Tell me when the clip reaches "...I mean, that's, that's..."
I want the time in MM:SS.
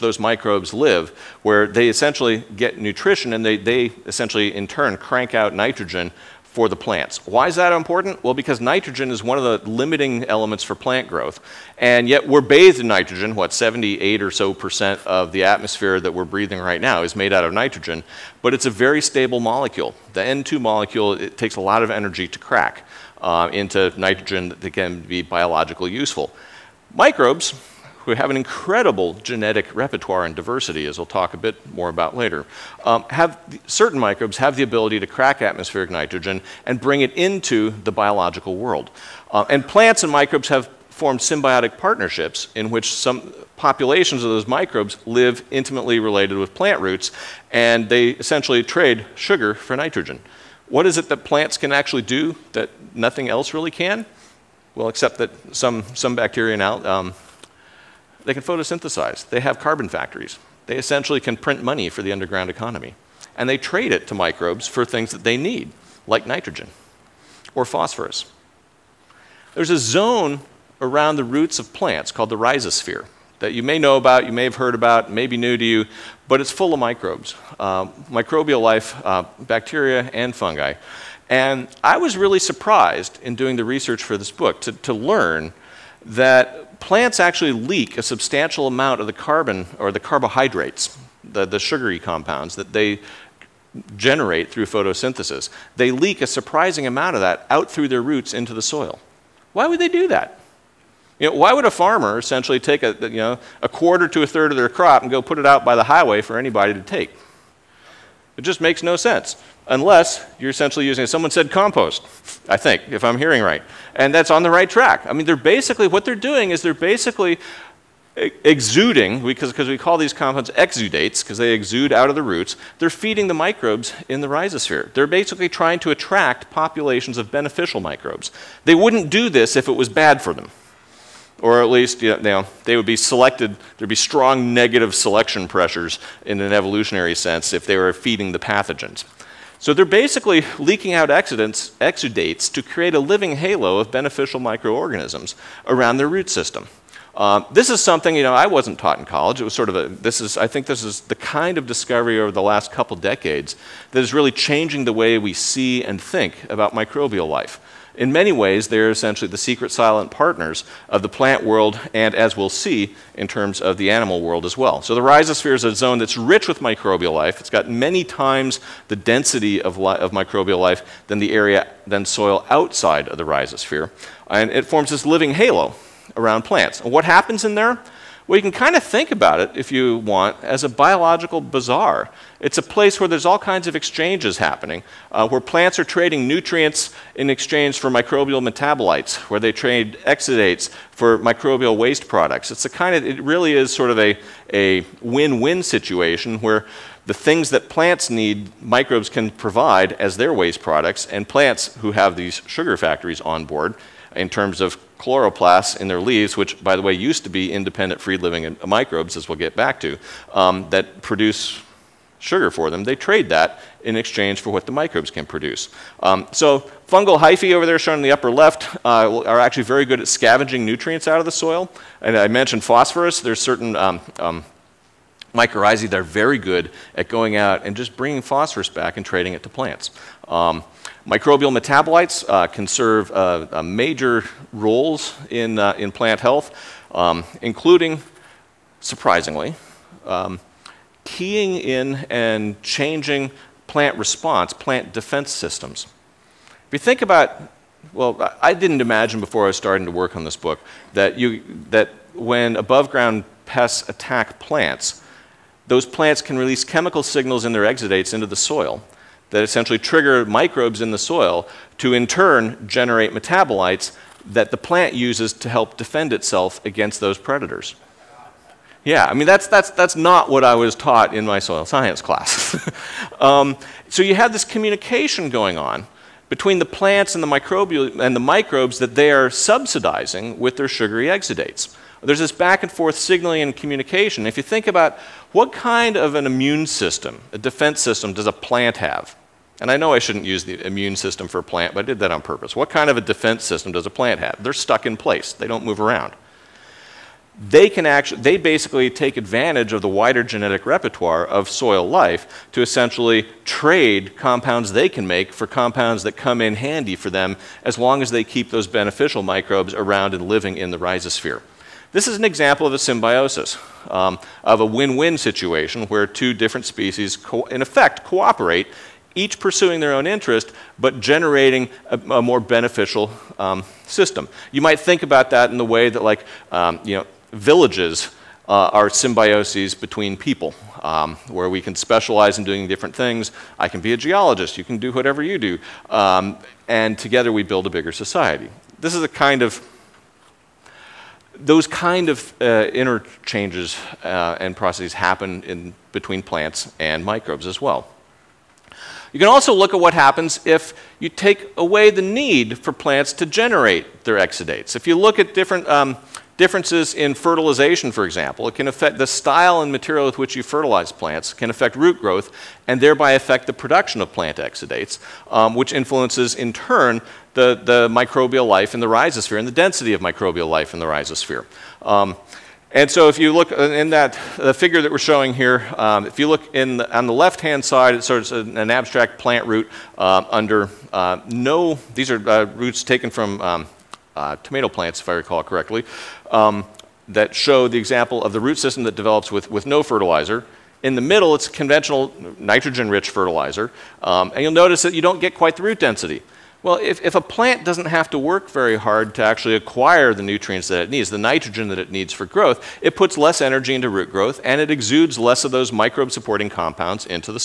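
04:29.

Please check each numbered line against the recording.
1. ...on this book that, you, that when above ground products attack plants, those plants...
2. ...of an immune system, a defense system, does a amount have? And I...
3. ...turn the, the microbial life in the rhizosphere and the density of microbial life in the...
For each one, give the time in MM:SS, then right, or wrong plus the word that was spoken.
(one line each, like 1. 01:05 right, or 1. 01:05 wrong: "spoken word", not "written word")
1. 04:10 wrong: "pests", not "products"
2. 04:45 wrong: "plant", not "amount"
3. 06:06 right.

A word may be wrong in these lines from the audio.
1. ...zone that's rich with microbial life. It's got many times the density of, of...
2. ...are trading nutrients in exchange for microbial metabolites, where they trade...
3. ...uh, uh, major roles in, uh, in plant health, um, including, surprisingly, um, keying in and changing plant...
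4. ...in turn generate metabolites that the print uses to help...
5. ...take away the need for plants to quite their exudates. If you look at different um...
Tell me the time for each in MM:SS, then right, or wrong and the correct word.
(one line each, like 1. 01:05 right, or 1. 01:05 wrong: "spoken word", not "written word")
1. 02:45 right
2. 03:05 right
3. 03:53 right
4. 04:21 wrong: "plant", not "print"
5. 05:51 wrong: "generate", not "quite".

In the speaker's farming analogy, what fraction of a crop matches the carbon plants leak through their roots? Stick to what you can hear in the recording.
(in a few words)
a quarter to a third.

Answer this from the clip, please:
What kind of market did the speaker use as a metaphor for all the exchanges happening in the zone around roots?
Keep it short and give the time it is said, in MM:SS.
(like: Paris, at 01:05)
biological bazaar, at 03:00.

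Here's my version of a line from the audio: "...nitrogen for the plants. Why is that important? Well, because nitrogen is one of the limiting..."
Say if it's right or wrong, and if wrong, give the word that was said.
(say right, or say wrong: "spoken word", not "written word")
right.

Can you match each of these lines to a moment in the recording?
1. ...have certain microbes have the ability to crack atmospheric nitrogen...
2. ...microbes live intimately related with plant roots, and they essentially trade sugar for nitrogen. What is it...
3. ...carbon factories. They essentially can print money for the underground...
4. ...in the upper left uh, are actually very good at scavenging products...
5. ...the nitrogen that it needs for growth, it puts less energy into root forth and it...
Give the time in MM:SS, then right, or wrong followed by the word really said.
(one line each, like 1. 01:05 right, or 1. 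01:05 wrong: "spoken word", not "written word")
1. 00:33 right
2. 00:44 right
3. 00:59 right
4. 03:37 wrong: "nutrients", not "products"
5. 06:41 wrong: "growth", not "forth".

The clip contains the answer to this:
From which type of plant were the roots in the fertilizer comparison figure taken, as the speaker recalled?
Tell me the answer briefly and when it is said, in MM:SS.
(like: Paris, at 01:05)
tomato, at 06:24.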